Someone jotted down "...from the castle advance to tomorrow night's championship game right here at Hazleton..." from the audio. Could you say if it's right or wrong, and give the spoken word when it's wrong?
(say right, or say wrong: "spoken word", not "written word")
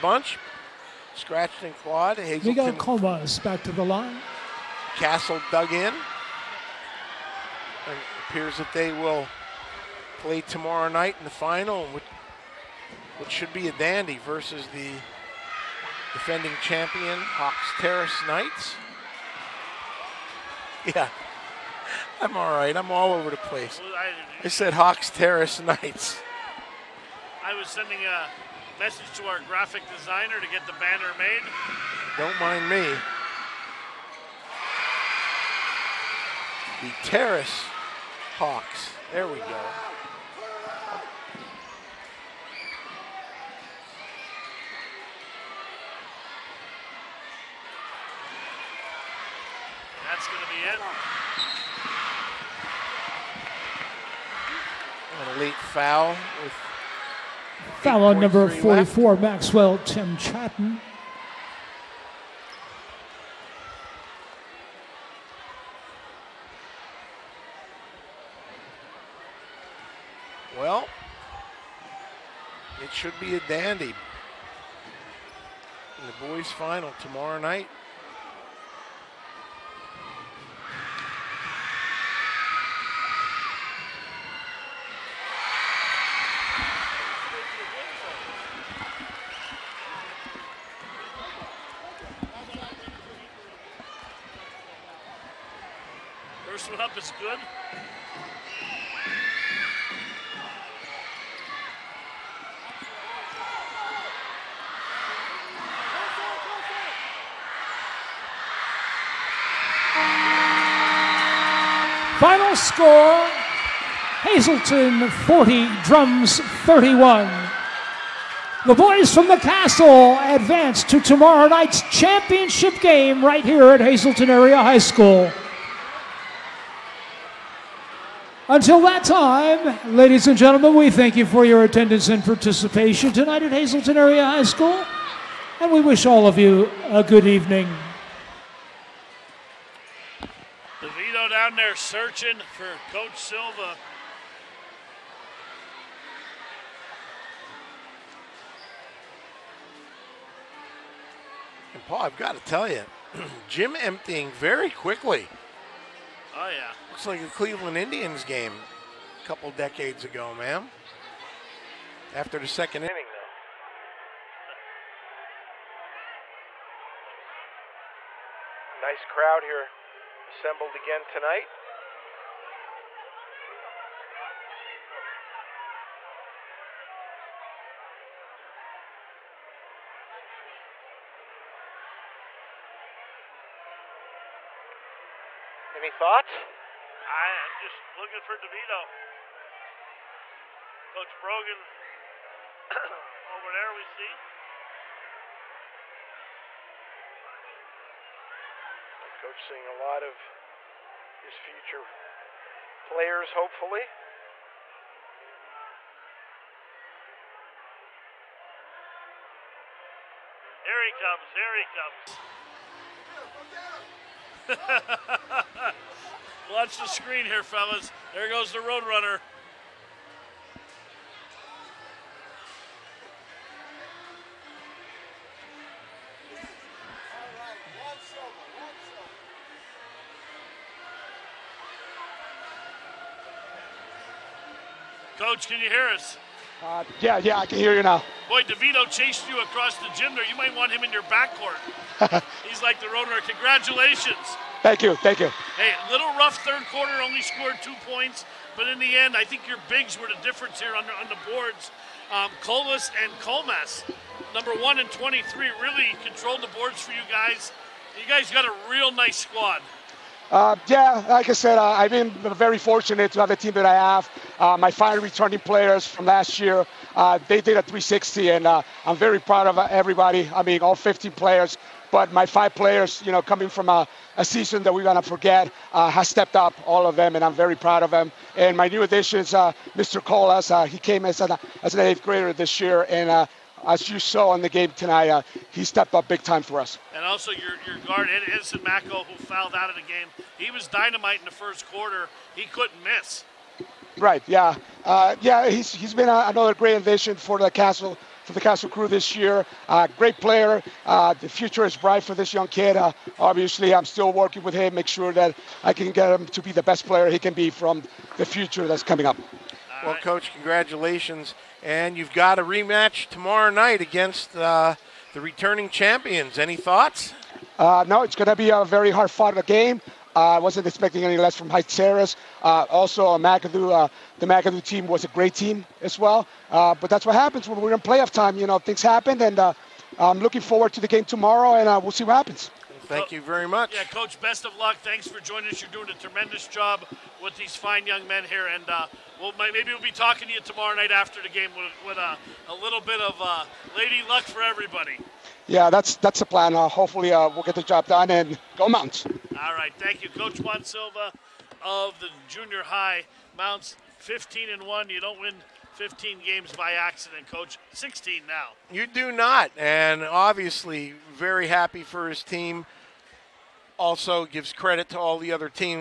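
right.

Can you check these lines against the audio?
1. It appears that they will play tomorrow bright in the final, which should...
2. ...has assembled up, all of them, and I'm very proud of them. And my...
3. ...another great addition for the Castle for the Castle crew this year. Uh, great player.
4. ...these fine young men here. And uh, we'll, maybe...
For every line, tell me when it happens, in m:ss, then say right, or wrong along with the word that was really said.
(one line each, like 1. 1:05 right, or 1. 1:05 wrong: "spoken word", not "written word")
1. 0:05 wrong: "night", not "bright"
2. 4:35 wrong: "stepped", not "assembled"
3. 4:56 right
4. 5:37 right.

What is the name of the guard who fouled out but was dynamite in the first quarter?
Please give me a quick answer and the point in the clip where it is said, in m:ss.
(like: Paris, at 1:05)
Edison Mako, at 4:48.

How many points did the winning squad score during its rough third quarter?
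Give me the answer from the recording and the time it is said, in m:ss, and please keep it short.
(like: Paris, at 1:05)
2, at 4:07.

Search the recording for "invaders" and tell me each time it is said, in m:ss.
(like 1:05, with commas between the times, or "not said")
not said.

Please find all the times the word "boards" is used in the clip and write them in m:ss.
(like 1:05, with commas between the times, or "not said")
4:11, 4:16.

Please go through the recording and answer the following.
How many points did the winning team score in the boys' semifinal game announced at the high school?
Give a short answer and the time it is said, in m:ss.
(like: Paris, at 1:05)
40, at 1:54.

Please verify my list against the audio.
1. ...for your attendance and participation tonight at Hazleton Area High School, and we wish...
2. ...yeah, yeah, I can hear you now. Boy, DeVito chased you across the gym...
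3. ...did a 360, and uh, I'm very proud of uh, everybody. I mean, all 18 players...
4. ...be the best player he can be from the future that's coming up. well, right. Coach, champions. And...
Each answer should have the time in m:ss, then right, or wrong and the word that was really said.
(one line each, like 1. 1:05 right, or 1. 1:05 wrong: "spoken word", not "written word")
1. 2:11 right
2. 3:56 right
3. 4:27 wrong: "15", not "18"
4. 5:06 wrong: "congratulations", not "champions".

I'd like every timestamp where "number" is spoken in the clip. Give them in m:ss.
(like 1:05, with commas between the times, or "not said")
0:58, 4:14.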